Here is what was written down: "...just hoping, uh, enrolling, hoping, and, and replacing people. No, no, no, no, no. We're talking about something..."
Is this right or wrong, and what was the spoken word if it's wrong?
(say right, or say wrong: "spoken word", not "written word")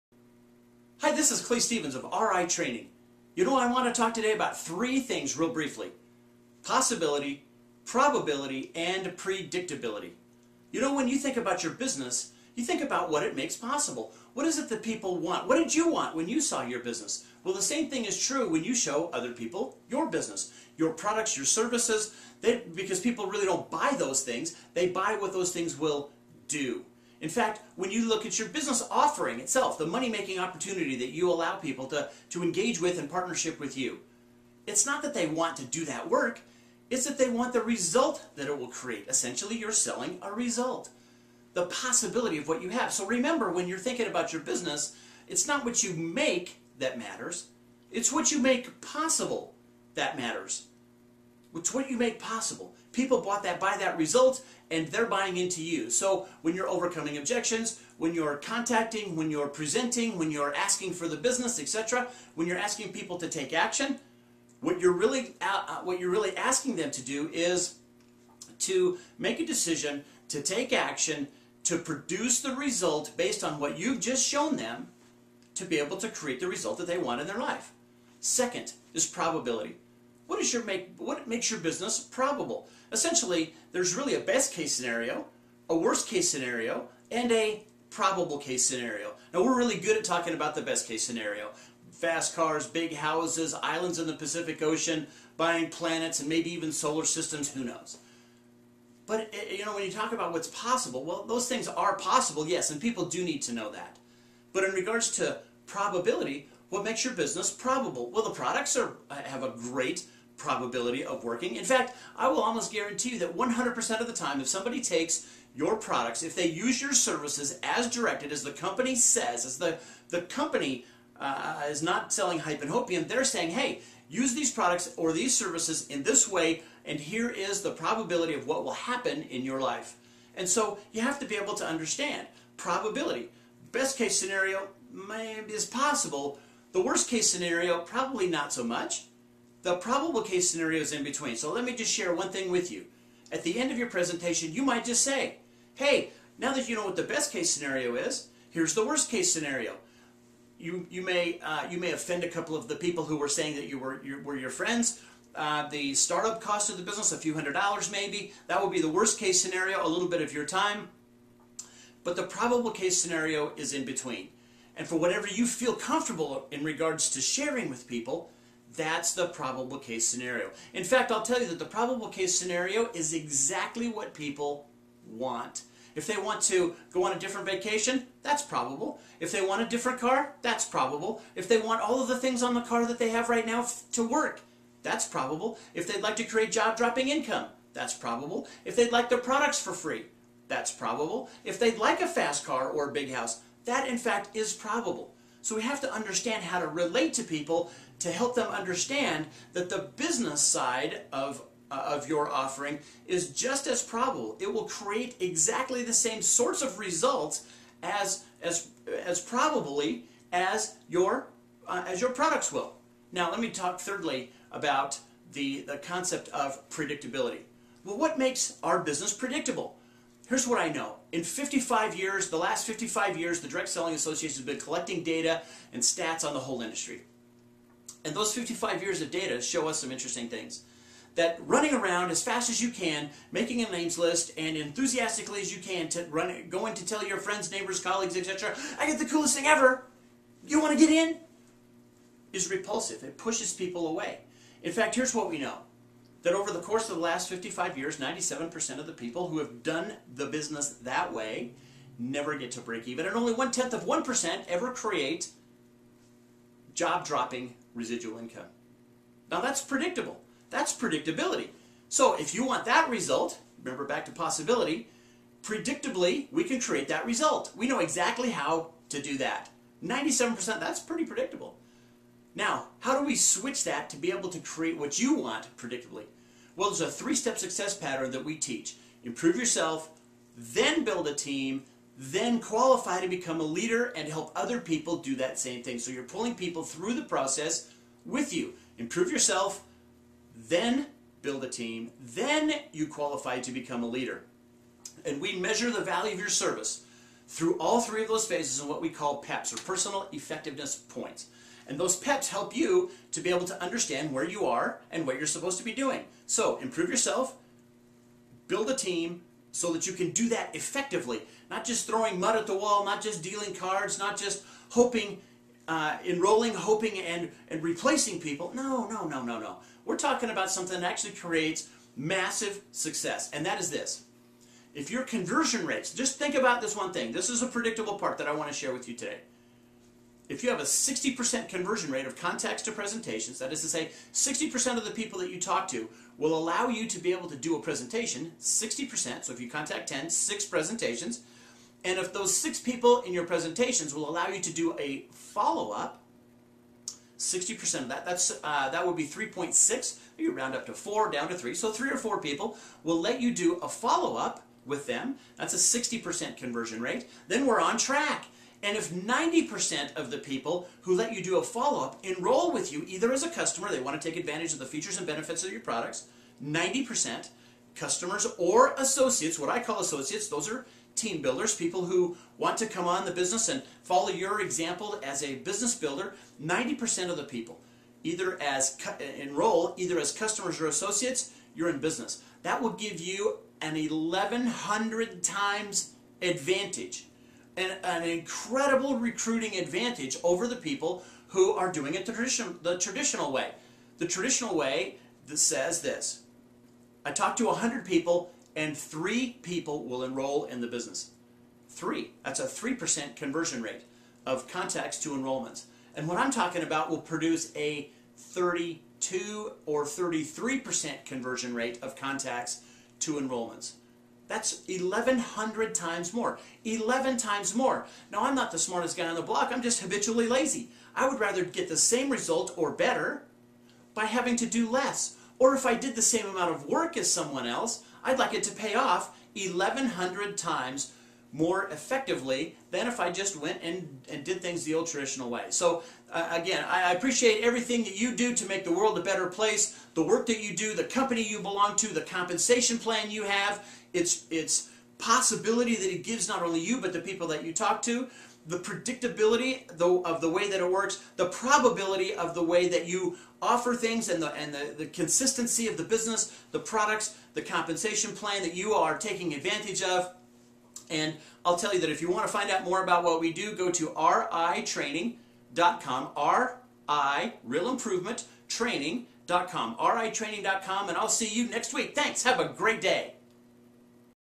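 right.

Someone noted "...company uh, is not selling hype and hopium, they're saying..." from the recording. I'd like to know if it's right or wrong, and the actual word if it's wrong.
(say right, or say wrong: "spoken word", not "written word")
right.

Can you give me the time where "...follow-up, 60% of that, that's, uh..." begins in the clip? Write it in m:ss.
5:45.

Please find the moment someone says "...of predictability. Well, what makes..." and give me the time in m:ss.
3:36.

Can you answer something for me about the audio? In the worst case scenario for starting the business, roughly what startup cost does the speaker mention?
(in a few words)
A few hundred dollars.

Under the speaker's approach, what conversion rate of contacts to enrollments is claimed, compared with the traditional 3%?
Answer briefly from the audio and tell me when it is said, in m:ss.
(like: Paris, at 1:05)
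32 or 33%, at 6:48.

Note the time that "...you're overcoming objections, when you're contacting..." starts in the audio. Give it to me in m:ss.
0:56.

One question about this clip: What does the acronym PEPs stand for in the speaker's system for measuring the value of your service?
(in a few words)
Personal Effectiveness Points.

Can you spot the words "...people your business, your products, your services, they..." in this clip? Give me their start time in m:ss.
0:19.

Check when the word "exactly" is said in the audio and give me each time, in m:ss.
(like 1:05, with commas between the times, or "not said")
2:53, 3:25, 4:27.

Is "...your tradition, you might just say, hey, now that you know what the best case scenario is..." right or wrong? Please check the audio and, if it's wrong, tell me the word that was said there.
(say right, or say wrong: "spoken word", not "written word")
wrong: "presentation", not "tradition".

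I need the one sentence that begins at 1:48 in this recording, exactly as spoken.
Well, the products are eh, have a great probability of working.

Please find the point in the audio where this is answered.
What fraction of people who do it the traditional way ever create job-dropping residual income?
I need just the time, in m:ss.
4:13.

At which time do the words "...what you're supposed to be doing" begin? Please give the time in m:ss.
5:05.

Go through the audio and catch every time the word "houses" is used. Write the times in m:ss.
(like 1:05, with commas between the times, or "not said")
1:32, 3:13.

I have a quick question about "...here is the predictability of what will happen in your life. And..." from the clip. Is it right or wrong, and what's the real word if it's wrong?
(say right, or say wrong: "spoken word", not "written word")
wrong: "probability", not "predictability".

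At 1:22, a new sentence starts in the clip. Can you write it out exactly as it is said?
Essentially, there's really a best case scenario, a worst case scenario, and a probable case scenario.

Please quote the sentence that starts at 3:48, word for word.
And those 55 years of data show us some interesting things.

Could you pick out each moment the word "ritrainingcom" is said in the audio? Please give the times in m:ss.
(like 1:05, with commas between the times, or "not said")
7:43, 7:49.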